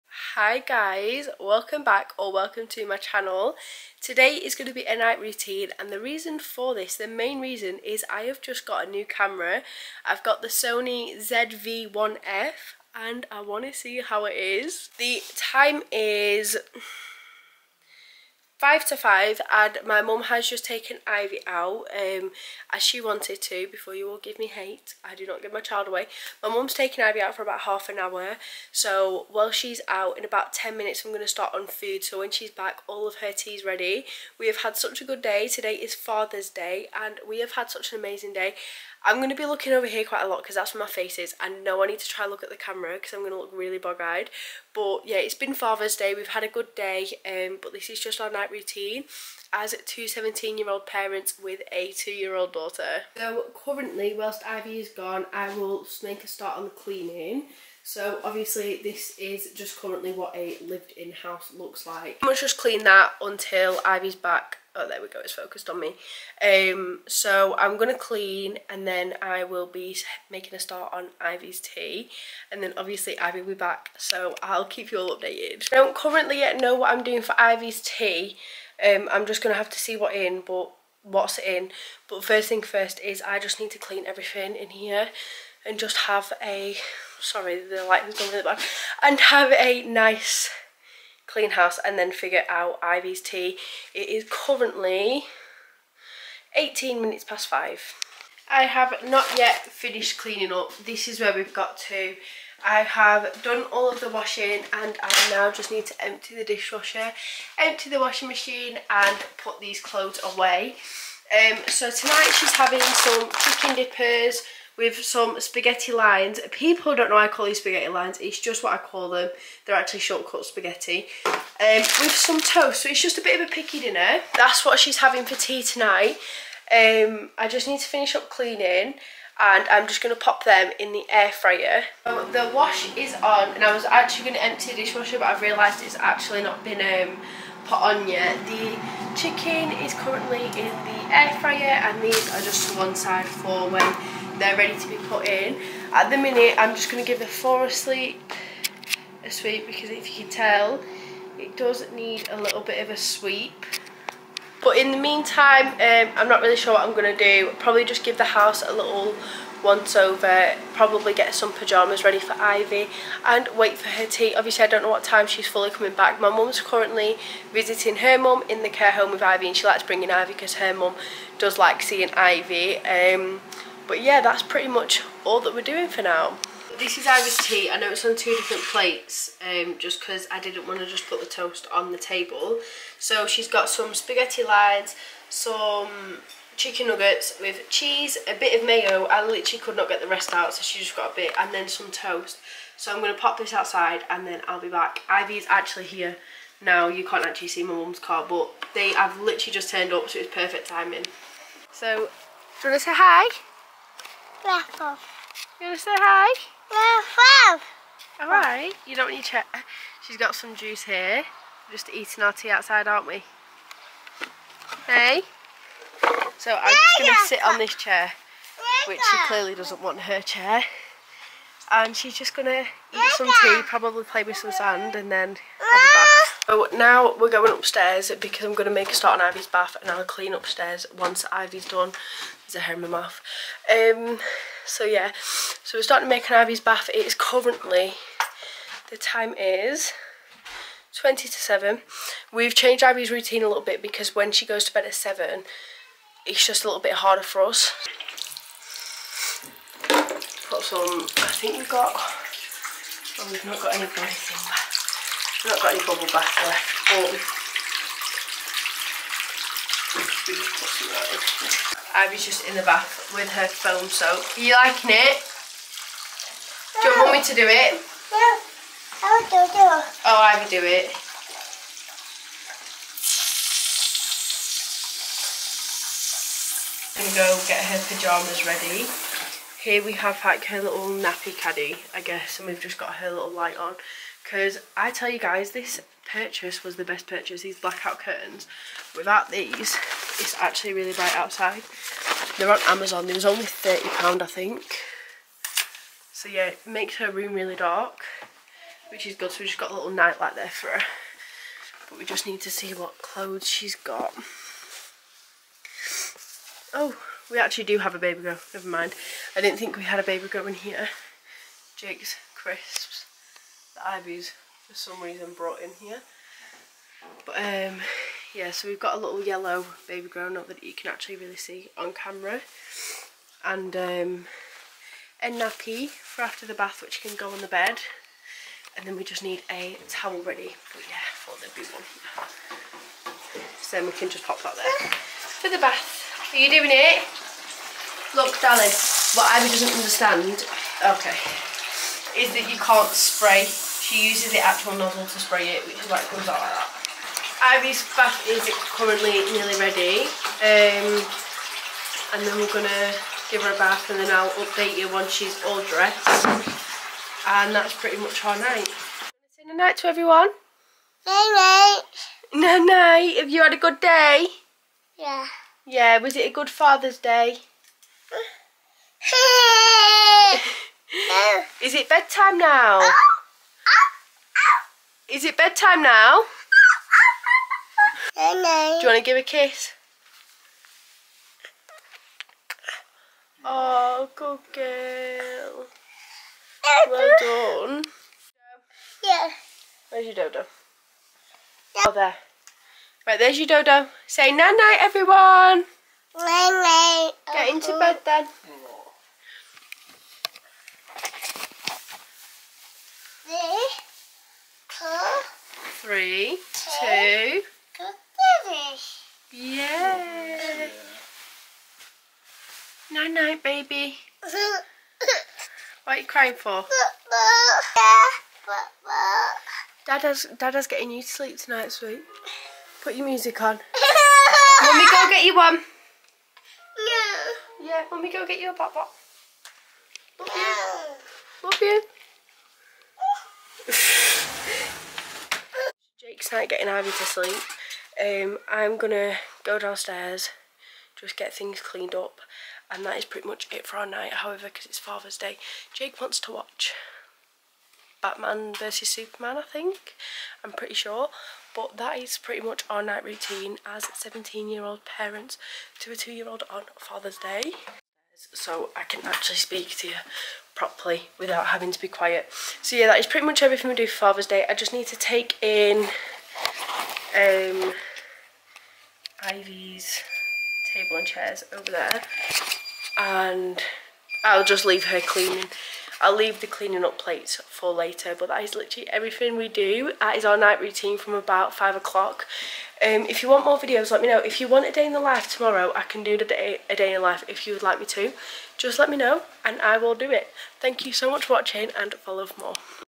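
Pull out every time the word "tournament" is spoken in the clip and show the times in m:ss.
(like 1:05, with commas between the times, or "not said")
not said.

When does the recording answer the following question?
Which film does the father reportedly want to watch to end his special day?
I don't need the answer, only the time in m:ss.
7:28.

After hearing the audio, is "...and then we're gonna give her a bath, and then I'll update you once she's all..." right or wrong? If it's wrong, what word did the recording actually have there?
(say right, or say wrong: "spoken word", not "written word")
right.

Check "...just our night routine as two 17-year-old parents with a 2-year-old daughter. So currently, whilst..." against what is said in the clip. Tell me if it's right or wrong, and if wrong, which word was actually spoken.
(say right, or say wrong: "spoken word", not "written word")
right.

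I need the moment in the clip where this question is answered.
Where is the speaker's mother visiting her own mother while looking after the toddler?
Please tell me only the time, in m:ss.
2:48.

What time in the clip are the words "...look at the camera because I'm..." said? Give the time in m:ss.
0:42.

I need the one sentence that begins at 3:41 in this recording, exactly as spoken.
And she's just going to eat some tea, probably play with some sand, and then have a bath.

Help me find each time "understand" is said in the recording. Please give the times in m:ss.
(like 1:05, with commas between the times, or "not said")
5:39.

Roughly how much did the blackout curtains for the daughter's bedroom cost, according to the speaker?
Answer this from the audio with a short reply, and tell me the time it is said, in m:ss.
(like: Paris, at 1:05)
£30, at 4:53.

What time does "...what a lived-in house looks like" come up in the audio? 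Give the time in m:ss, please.
1:00.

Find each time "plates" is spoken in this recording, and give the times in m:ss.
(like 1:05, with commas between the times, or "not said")
2:58, 7:56.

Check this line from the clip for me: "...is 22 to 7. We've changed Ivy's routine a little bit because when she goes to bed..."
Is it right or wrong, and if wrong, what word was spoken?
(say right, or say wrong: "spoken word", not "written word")
wrong: "20", not "22".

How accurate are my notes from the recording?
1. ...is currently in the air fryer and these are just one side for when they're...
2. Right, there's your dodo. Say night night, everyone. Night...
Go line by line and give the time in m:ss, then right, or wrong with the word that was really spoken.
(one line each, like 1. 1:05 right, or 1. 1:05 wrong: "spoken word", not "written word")
1. 2:19 right
2. 6:33 right.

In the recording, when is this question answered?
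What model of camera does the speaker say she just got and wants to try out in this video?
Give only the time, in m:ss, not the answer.
0:10.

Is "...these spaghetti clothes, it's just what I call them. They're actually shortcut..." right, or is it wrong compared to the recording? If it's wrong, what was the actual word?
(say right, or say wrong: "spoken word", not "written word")
wrong: "lines", not "clothes".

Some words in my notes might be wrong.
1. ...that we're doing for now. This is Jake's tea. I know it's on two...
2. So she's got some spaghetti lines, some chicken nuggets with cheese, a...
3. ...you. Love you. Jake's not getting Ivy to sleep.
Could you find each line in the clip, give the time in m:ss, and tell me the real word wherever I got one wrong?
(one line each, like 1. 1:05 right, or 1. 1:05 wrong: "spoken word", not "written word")
1. 2:55 wrong: "Ivy", not "Jake"
2. 3:02 right
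3. 7:10 right.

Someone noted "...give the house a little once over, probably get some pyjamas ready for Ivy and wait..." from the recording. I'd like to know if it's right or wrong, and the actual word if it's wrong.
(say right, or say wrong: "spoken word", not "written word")
right.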